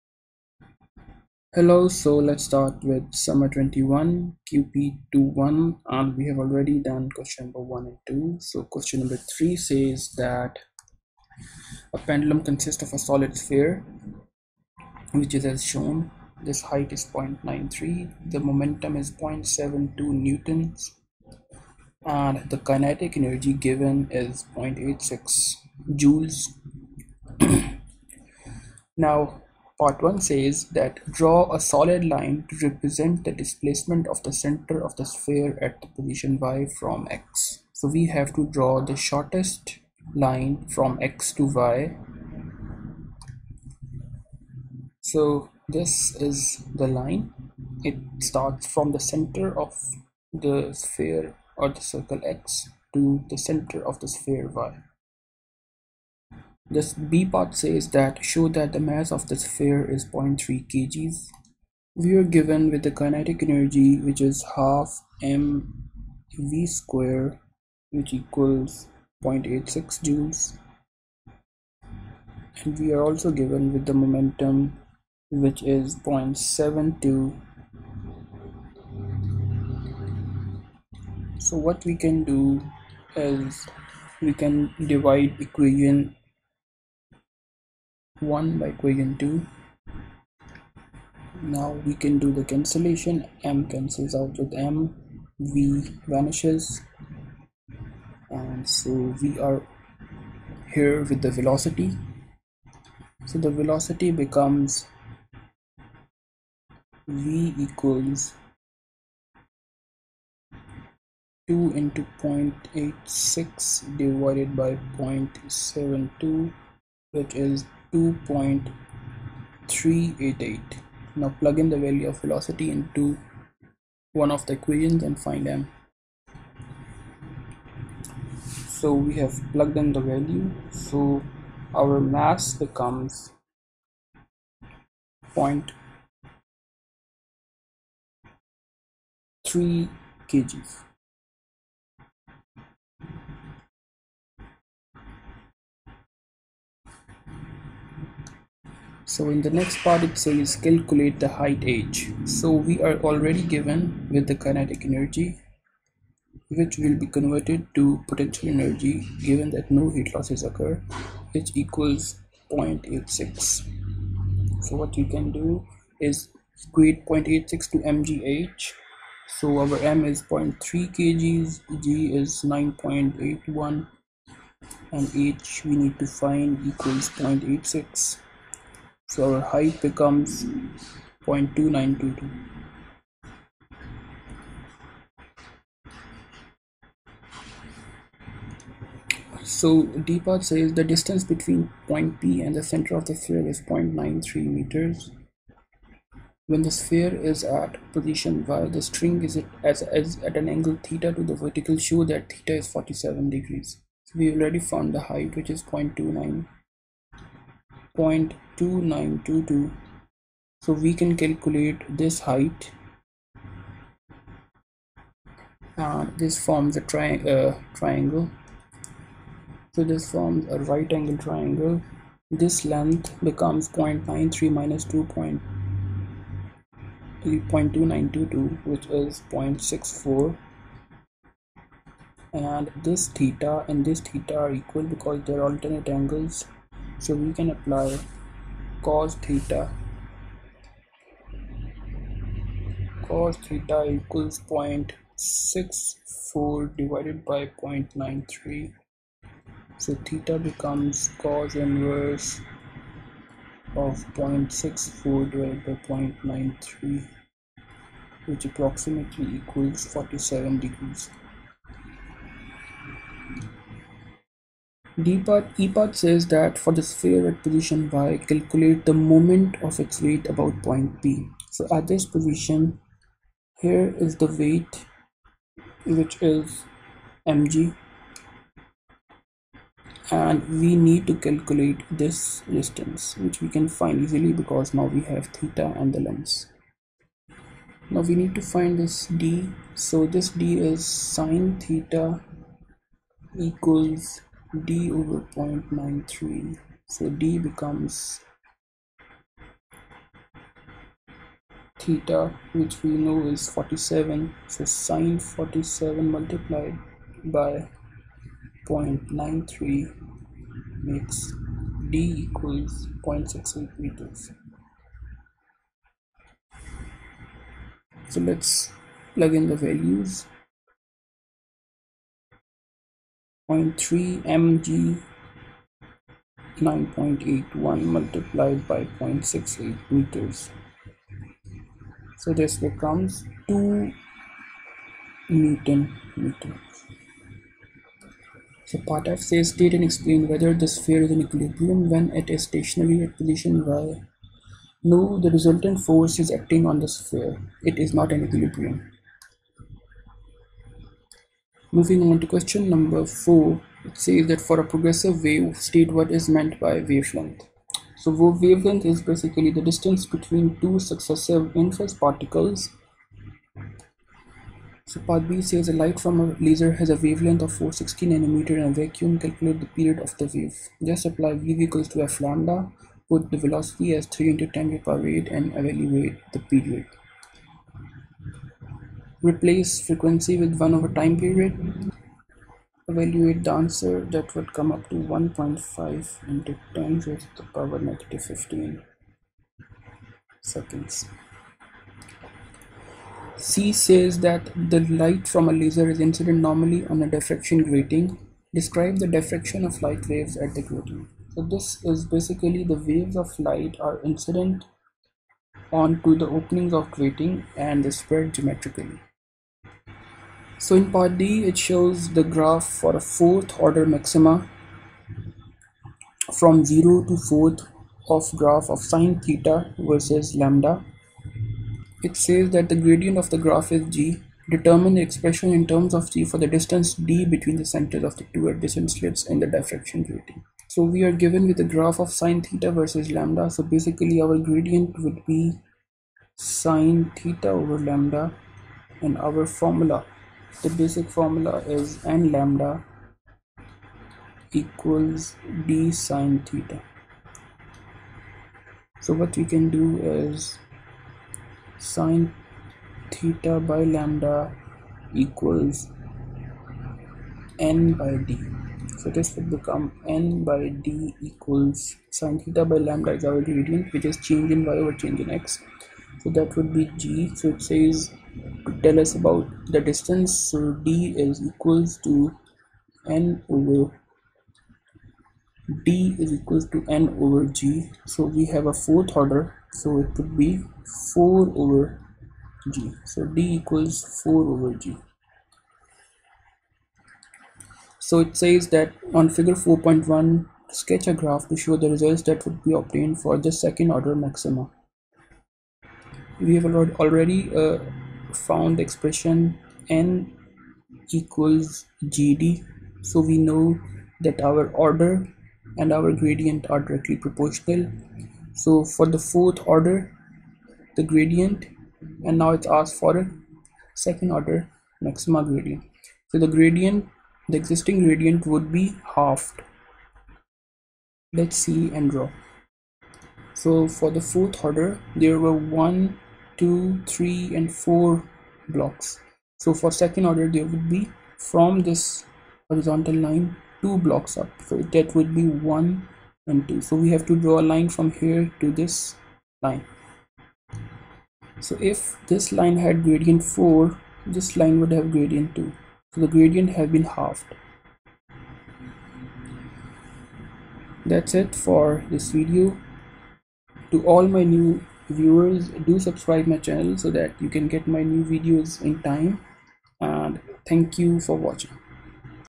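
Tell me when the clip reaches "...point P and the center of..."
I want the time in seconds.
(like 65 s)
191 s.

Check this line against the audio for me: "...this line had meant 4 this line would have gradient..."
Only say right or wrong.
wrong.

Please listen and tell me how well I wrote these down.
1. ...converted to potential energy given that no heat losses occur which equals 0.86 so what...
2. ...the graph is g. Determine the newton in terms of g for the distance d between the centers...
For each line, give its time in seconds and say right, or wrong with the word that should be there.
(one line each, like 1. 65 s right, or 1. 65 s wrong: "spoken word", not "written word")
1. 157 s right
2. 423 s wrong: "expression", not "newton".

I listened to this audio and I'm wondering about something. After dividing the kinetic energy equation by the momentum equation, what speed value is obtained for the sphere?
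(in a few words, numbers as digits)
2.388.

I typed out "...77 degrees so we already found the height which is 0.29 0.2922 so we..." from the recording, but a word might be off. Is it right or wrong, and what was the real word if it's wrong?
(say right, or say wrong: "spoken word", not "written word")
wrong: "47", not "77".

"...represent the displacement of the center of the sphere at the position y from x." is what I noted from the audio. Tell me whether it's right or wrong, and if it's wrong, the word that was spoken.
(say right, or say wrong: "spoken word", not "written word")
right.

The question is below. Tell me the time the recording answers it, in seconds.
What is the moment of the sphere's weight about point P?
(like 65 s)
333 s.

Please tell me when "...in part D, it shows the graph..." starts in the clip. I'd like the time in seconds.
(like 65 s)
410 s.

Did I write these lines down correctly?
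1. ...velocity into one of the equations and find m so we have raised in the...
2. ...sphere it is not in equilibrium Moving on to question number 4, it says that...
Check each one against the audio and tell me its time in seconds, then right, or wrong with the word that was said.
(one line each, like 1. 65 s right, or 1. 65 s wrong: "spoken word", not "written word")
1. 122 s wrong: "plugged", not "raised"
2. 346 s right.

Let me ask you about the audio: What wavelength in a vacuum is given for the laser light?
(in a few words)
460 nanometers.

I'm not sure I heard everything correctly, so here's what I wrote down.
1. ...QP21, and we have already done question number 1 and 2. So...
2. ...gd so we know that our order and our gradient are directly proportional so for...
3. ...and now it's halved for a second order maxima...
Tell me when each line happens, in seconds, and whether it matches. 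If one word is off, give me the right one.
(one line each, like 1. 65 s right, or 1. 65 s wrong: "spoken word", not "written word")
1. 4 s right
2. 502 s right
3. 512 s wrong: "asked", not "halved".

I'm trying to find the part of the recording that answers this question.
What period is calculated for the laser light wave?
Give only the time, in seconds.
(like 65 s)
384 s.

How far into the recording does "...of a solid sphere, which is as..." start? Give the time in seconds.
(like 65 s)
12 s.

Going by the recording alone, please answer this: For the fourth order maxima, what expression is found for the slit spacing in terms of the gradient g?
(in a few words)
d = 4/g.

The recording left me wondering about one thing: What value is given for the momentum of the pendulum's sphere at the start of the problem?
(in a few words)
0.72 newtons.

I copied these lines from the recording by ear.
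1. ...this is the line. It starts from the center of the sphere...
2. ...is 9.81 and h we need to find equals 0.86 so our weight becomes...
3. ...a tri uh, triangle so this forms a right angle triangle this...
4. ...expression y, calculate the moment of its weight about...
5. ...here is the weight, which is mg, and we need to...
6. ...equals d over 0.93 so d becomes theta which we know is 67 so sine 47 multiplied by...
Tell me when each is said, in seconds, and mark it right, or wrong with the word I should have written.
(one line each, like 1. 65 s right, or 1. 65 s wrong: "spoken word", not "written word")
1. 45 s right
2. 172 s wrong: "height", not "weight"
3. 216 s right
4. 267 s wrong: "position", not "expression"
5. 273 s right
6. 293 s wrong: "47", not "67".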